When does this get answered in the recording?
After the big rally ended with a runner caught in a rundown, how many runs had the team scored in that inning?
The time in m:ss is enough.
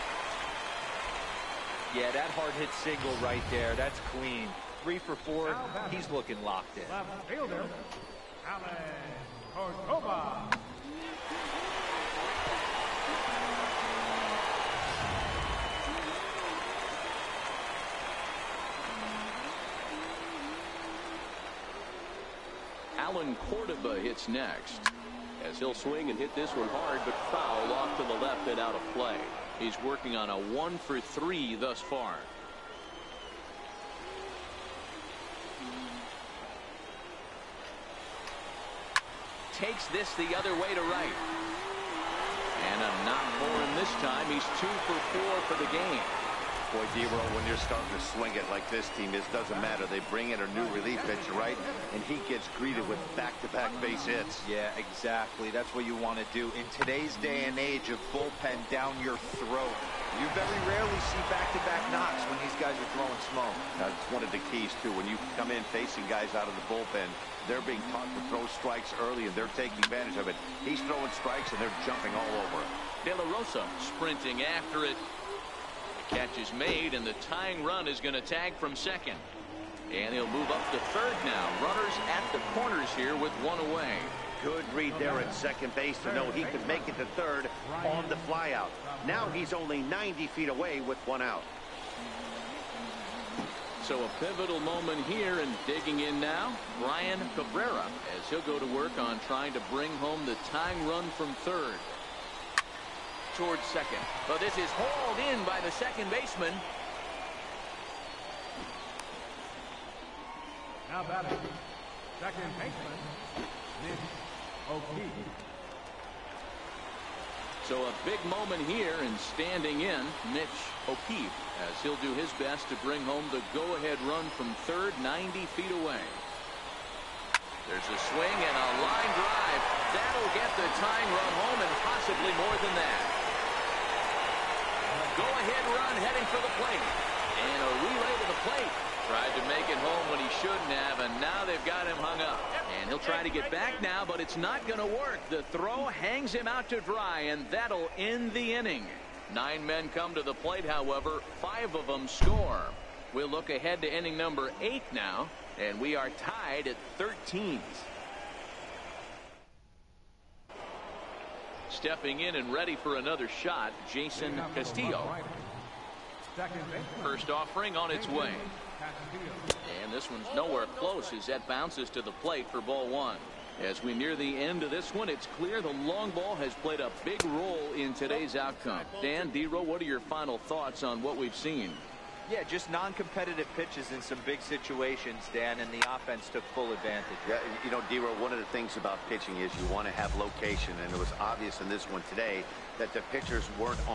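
2:31.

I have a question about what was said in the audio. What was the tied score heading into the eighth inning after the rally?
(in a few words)
13-13.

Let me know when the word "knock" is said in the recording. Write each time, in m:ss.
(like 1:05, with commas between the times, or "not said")
0:43, 1:02.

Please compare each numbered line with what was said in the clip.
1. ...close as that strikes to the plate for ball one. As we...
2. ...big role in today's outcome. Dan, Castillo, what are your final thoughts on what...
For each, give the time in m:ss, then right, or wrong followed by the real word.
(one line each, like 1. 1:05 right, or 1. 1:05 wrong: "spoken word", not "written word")
1. 2:50 wrong: "bounces", not "strikes"
2. 2:57 wrong: "Dero", not "Castillo".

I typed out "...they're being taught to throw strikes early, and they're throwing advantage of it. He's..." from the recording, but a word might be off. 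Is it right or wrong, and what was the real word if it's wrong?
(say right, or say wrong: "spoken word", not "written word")
wrong: "taking", not "throwing".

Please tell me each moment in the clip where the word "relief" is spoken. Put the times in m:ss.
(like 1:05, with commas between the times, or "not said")
0:50.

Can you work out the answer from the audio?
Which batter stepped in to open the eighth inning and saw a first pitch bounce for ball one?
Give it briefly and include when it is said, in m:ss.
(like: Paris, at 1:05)
Jason Castillo, at 2:43.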